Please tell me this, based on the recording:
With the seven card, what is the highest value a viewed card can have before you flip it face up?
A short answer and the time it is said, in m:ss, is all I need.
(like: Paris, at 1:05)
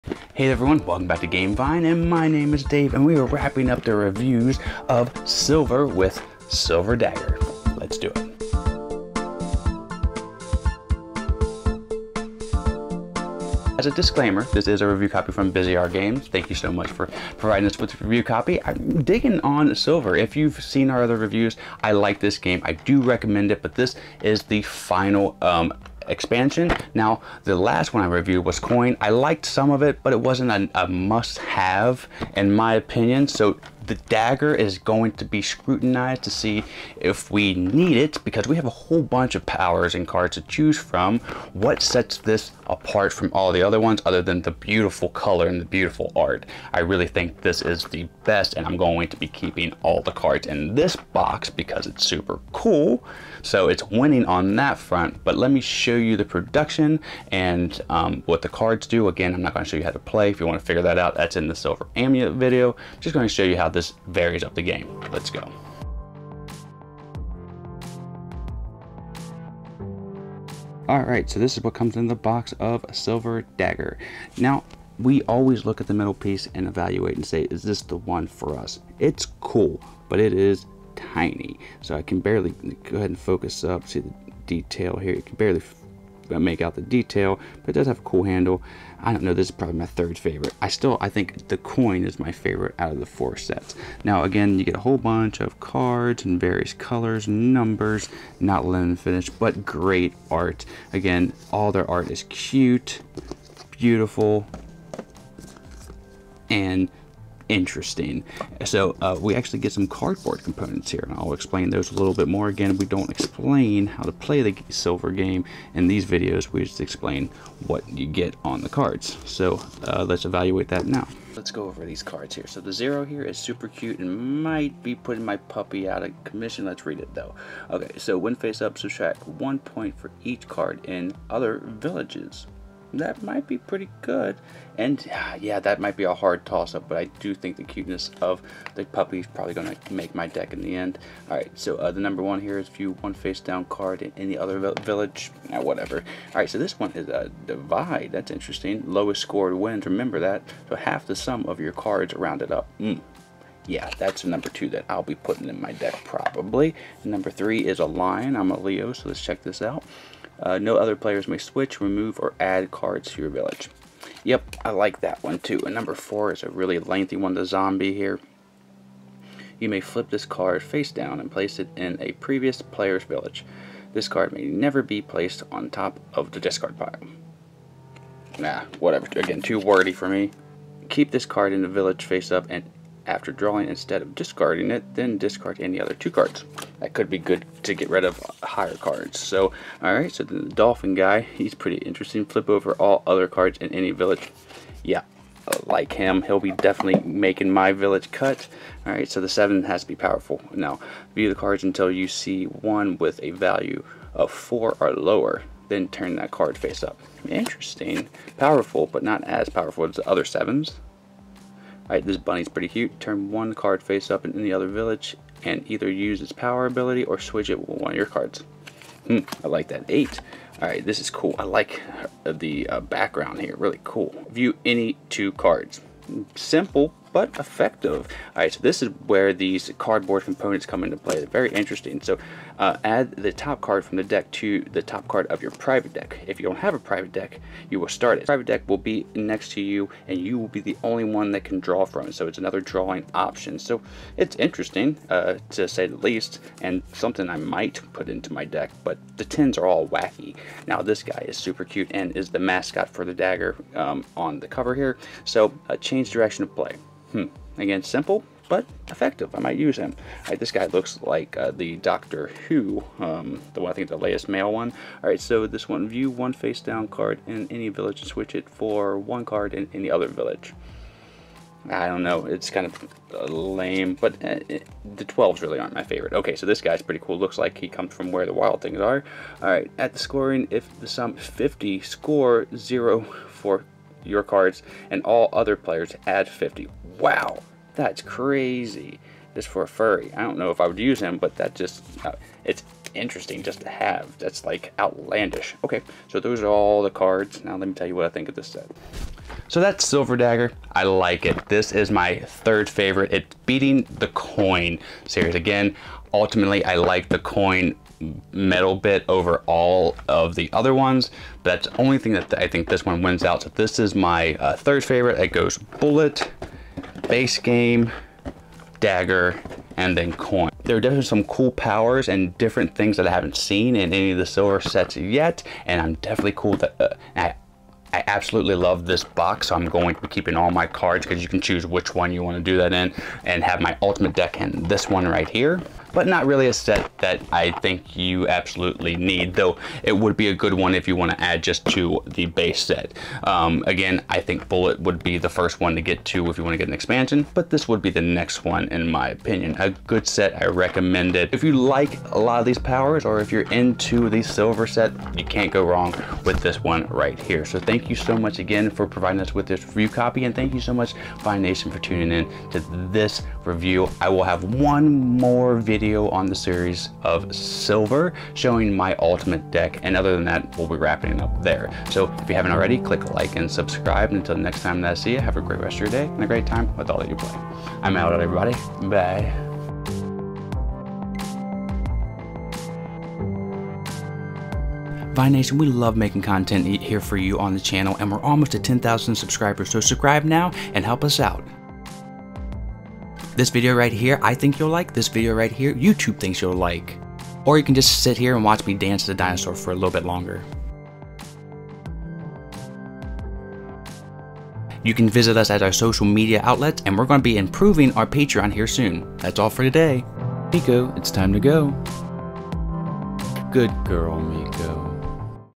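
4, at 3:24.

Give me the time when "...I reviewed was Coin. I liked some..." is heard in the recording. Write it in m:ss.
0:28.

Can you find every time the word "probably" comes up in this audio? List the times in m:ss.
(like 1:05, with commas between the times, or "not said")
1:29, 2:19, 2:36.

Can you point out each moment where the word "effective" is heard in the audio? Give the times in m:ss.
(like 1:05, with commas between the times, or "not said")
3:47, 4:18.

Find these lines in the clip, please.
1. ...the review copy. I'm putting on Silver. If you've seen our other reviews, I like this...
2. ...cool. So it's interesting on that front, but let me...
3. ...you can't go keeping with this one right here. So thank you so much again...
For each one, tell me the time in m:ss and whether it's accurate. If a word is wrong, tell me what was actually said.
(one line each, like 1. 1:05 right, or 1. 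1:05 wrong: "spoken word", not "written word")
1. 0:17 wrong: "digging", not "putting"
2. 0:52 wrong: "winning", not "interesting"
3. 5:55 wrong: "wrong", not "keeping".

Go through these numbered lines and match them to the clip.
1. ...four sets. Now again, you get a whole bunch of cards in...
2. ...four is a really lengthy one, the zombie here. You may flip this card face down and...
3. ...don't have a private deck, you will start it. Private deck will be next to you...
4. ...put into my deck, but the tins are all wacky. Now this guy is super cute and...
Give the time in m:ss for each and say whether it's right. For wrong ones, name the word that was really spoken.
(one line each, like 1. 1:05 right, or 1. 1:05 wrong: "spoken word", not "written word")
1. 1:33 right
2. 2:45 right
3. 3:56 right
4. 4:07 right.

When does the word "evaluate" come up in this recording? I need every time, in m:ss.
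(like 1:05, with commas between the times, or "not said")
1:16, 2:00.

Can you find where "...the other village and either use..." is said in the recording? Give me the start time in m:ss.
3:34.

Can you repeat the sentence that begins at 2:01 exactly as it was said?
Let's go over these cards here.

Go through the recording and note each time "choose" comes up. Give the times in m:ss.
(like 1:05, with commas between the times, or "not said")
0:40, 5:31.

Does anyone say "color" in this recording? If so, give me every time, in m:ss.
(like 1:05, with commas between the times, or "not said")
0:45, 1:36.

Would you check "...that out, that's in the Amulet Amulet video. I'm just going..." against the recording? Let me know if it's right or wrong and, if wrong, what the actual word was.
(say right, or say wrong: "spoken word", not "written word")
wrong: "Silver", not "Amulet".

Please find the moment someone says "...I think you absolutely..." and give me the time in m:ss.
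5:37.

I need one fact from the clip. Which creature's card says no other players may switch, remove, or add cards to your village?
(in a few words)
Lion.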